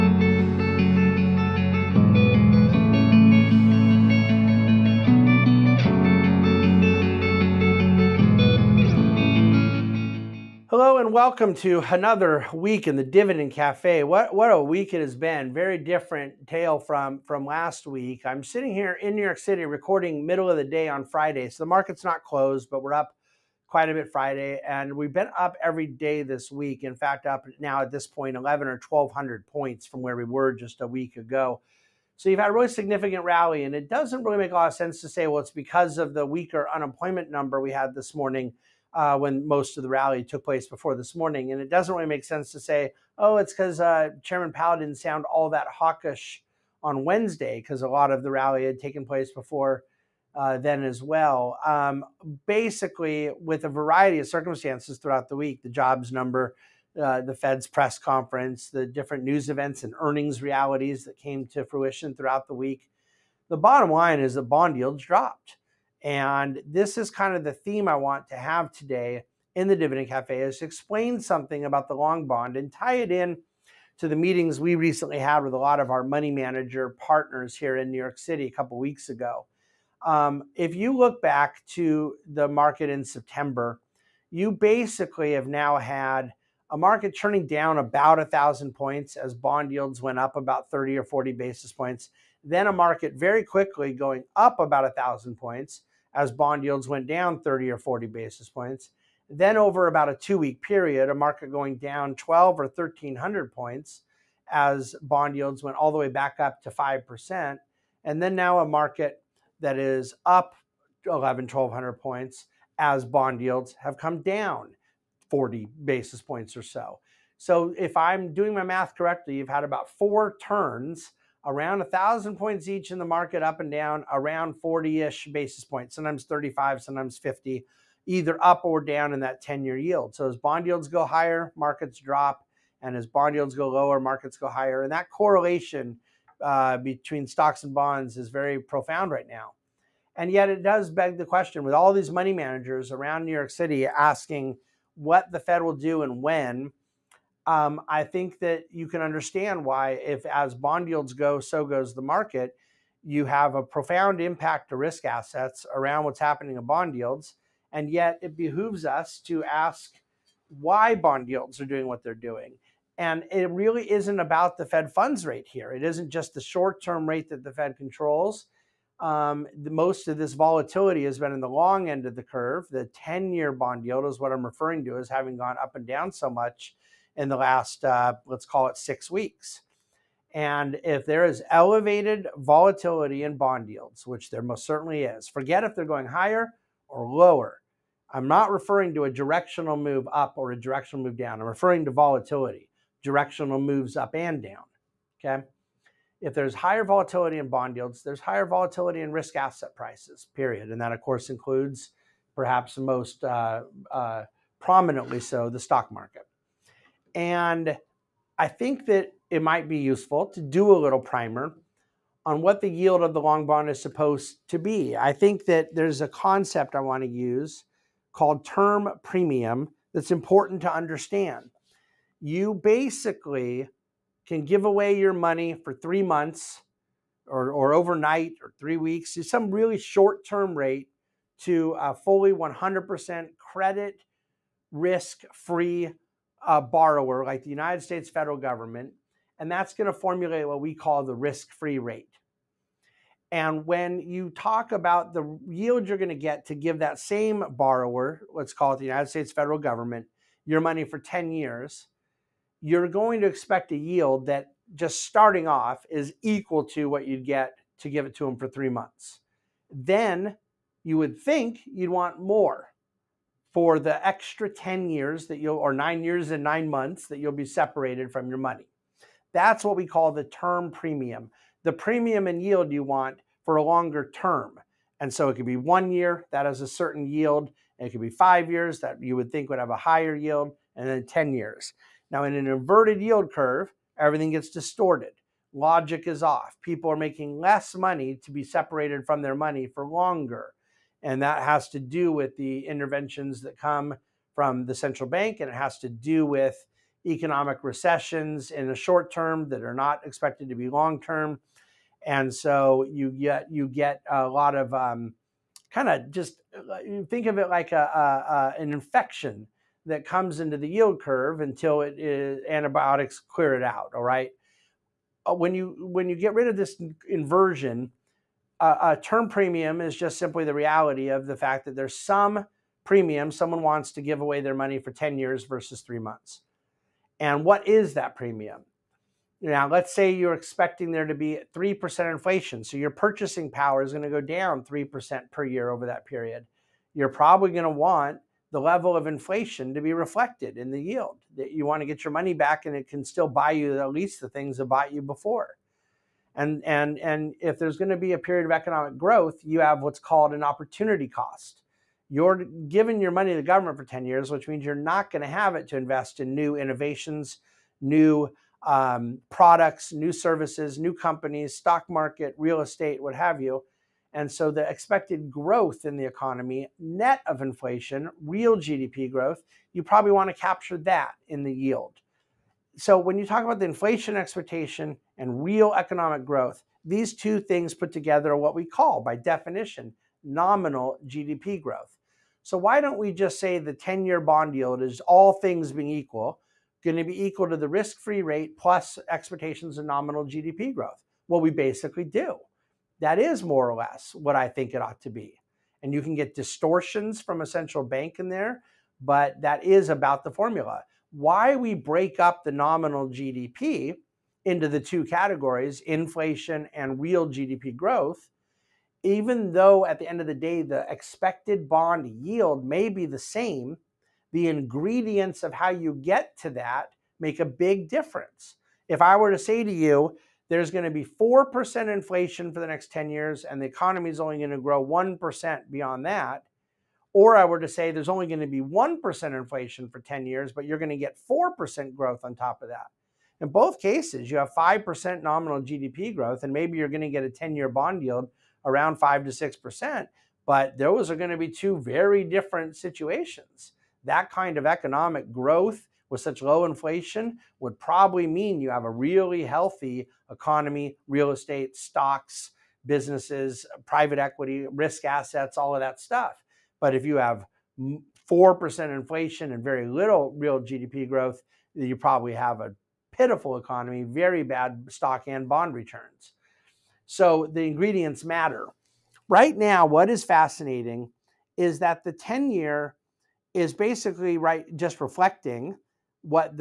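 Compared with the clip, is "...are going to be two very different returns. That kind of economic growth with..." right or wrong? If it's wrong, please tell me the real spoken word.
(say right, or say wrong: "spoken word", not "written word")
wrong: "situations", not "returns".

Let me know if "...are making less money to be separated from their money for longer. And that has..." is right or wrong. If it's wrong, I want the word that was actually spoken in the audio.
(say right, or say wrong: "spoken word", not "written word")
right.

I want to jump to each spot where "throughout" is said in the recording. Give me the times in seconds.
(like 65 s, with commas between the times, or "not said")
54 s, 62 s.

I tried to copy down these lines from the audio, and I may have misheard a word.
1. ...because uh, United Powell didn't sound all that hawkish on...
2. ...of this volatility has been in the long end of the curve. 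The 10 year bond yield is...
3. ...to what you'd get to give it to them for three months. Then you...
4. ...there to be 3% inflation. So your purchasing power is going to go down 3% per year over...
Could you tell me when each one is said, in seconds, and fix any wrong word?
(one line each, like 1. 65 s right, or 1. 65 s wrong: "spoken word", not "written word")
1. 43 s wrong: "Chairman", not "United"
2. 170 s right
3. 256 s right
4. 330 s right.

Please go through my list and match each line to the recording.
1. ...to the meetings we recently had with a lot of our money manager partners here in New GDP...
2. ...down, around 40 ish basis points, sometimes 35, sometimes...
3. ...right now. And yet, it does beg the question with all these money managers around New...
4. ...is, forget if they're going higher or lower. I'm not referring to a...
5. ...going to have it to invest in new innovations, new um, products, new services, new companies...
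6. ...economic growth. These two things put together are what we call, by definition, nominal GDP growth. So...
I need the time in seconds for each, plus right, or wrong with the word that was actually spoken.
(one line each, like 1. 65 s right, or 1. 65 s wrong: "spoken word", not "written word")
1. 73 s wrong: "York", not "GDP"
2. 123 s right
3. 139 s right
4. 185 s right
5. 355 s right
6. 375 s right.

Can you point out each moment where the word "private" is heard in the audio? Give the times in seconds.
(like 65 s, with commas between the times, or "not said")
453 s.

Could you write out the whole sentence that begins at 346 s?
And, and, and if there's going to be a period of economic growth, you have what's called an opportunity cost.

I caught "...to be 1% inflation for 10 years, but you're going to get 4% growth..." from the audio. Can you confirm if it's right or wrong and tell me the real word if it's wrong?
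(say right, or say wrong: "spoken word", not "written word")
right.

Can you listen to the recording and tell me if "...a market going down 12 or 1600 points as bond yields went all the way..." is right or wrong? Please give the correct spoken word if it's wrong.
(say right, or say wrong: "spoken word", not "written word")
wrong: "1300", not "1600".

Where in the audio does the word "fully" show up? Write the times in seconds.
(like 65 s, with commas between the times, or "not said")
231 s.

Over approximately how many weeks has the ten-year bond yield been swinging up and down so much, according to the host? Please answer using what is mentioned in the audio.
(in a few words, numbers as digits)
6.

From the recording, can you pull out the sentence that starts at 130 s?
So as bond yields go higher, markets drop.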